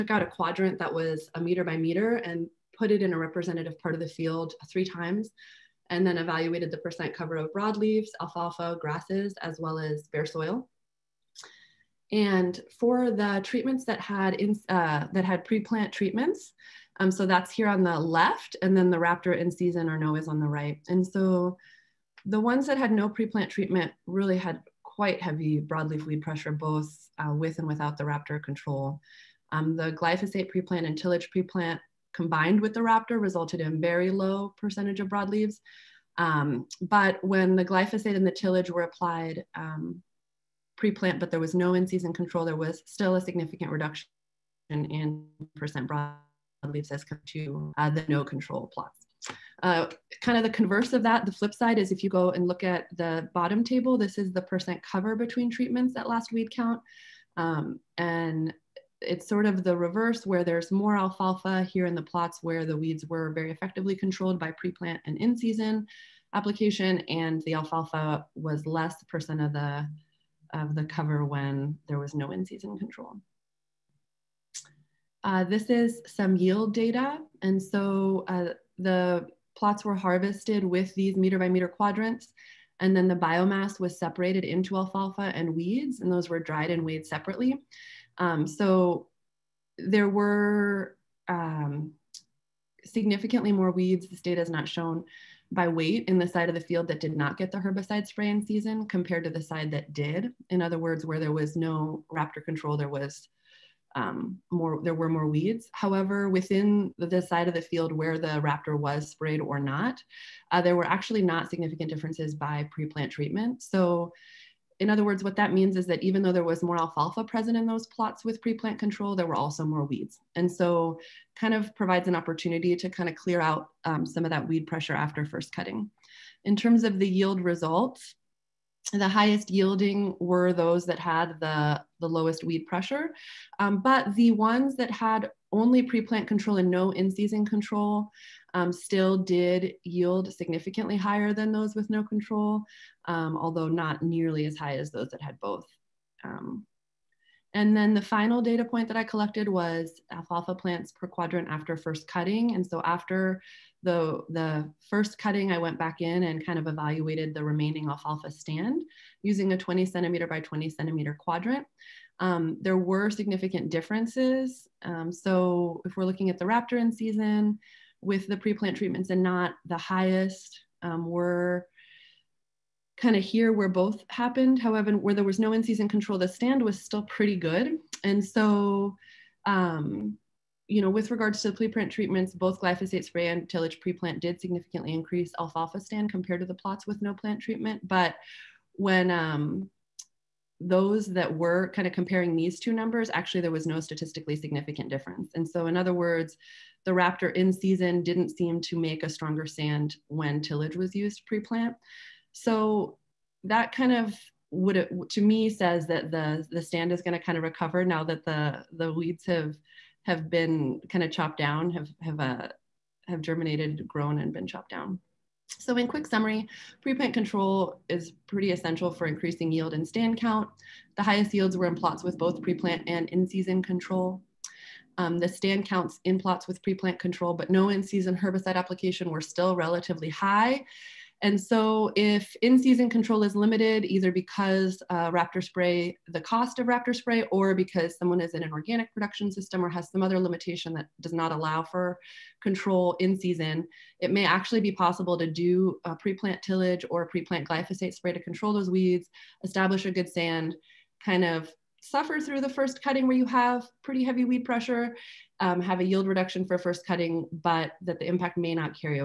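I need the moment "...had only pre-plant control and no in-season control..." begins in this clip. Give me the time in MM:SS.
02:14.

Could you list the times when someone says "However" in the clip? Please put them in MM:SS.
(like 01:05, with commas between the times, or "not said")
01:45, 02:54.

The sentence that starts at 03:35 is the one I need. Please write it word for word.
So in quick summary, pre-plant control is pretty essential for increasing yield and stand count.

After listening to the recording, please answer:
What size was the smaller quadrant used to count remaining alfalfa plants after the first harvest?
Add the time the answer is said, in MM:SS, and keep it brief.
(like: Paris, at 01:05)
20 cm by 20 cm, at 02:39.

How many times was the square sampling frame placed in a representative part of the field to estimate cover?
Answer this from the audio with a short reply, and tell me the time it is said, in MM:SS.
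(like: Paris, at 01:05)
3 times, at 00:04.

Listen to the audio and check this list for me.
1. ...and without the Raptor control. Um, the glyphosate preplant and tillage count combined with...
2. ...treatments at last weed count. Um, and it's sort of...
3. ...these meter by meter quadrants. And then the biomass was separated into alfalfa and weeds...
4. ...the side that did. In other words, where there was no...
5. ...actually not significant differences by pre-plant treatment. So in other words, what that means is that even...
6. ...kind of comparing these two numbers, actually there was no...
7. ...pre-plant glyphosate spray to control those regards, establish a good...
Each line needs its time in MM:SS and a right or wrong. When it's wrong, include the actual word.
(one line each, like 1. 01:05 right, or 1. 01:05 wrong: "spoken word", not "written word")
1. 00:27 wrong: "preplant", not "count"
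2. 00:55 right
3. 01:20 right
4. 01:39 right
5. 01:50 right
6. 03:11 right
7. 04:07 wrong: "weeds", not "regards".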